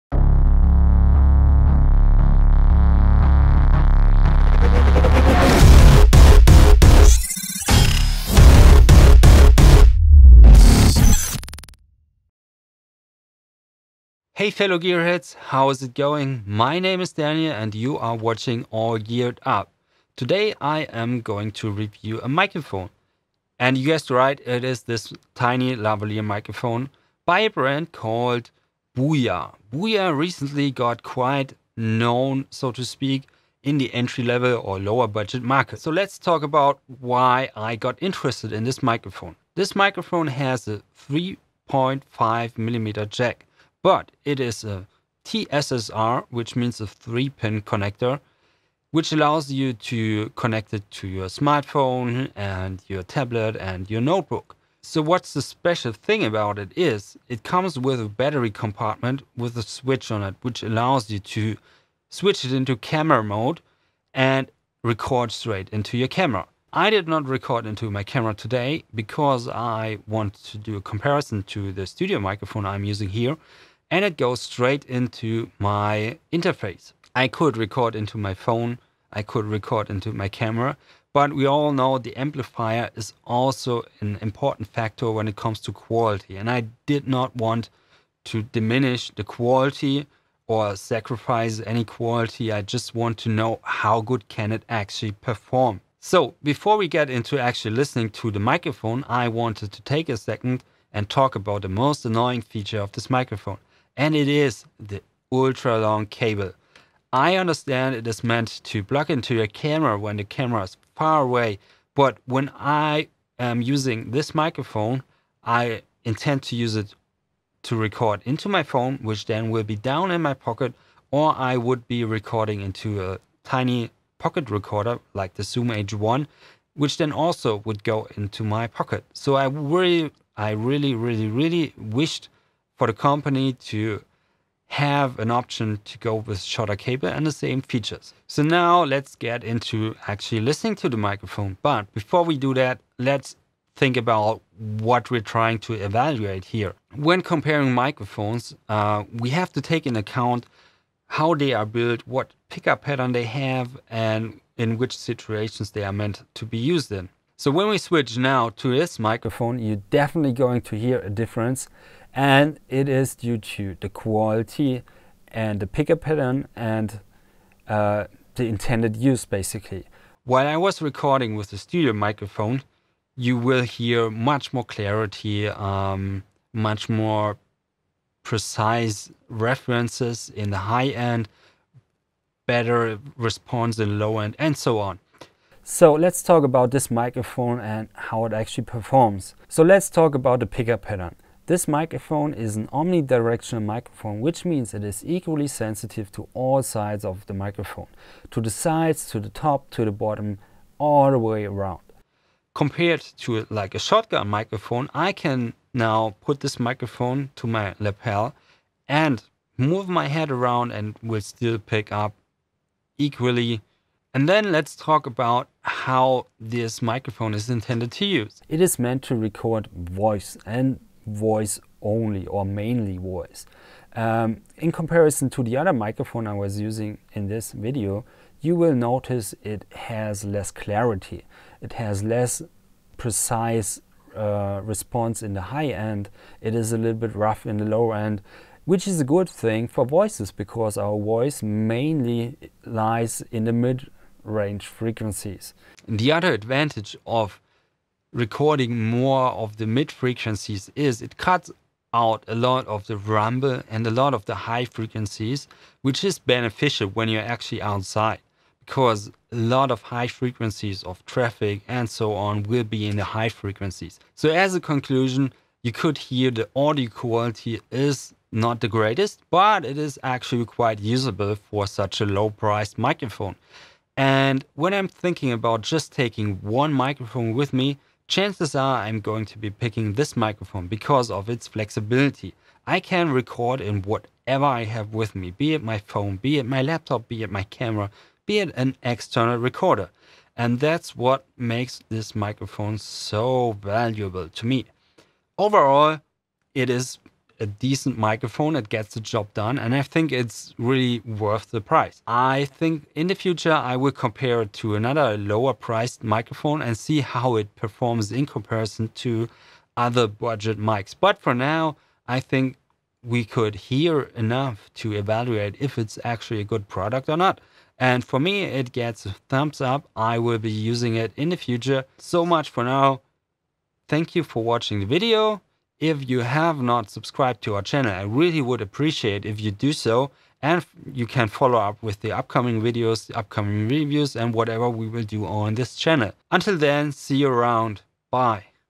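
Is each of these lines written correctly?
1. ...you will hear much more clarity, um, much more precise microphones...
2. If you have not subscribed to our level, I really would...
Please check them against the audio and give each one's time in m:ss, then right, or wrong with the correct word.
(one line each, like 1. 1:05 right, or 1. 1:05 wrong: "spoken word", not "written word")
1. 2:53 wrong: "references", not "microphones"
2. 5:25 wrong: "channel", not "level".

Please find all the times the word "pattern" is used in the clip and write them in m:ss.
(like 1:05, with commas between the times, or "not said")
2:32, 2:46, 3:10.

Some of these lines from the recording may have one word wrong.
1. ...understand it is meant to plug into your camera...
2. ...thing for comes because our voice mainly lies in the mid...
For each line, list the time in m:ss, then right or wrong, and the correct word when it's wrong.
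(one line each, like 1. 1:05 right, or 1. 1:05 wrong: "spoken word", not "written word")
1. 1:47 right
2. 3:59 wrong: "voices", not "comes".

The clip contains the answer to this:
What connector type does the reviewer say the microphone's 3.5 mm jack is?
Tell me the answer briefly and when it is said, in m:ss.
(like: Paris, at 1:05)
TSSR, at 0:45.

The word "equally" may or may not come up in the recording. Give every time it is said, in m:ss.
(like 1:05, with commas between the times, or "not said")
3:15, 3:32.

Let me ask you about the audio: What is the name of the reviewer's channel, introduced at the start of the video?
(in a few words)
All Geared Up.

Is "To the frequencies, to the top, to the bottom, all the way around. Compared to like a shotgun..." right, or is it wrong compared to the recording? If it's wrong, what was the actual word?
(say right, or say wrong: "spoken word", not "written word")
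wrong: "sides", not "frequencies".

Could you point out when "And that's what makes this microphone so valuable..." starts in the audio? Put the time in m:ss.
4:50.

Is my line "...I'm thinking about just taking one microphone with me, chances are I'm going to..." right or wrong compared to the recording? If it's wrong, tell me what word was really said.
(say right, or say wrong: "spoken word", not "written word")
right.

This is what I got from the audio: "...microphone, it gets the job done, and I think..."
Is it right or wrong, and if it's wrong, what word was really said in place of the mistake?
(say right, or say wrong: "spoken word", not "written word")
right.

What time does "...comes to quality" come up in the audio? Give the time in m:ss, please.
1:25.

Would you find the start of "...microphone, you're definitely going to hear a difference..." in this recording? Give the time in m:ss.
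2:38.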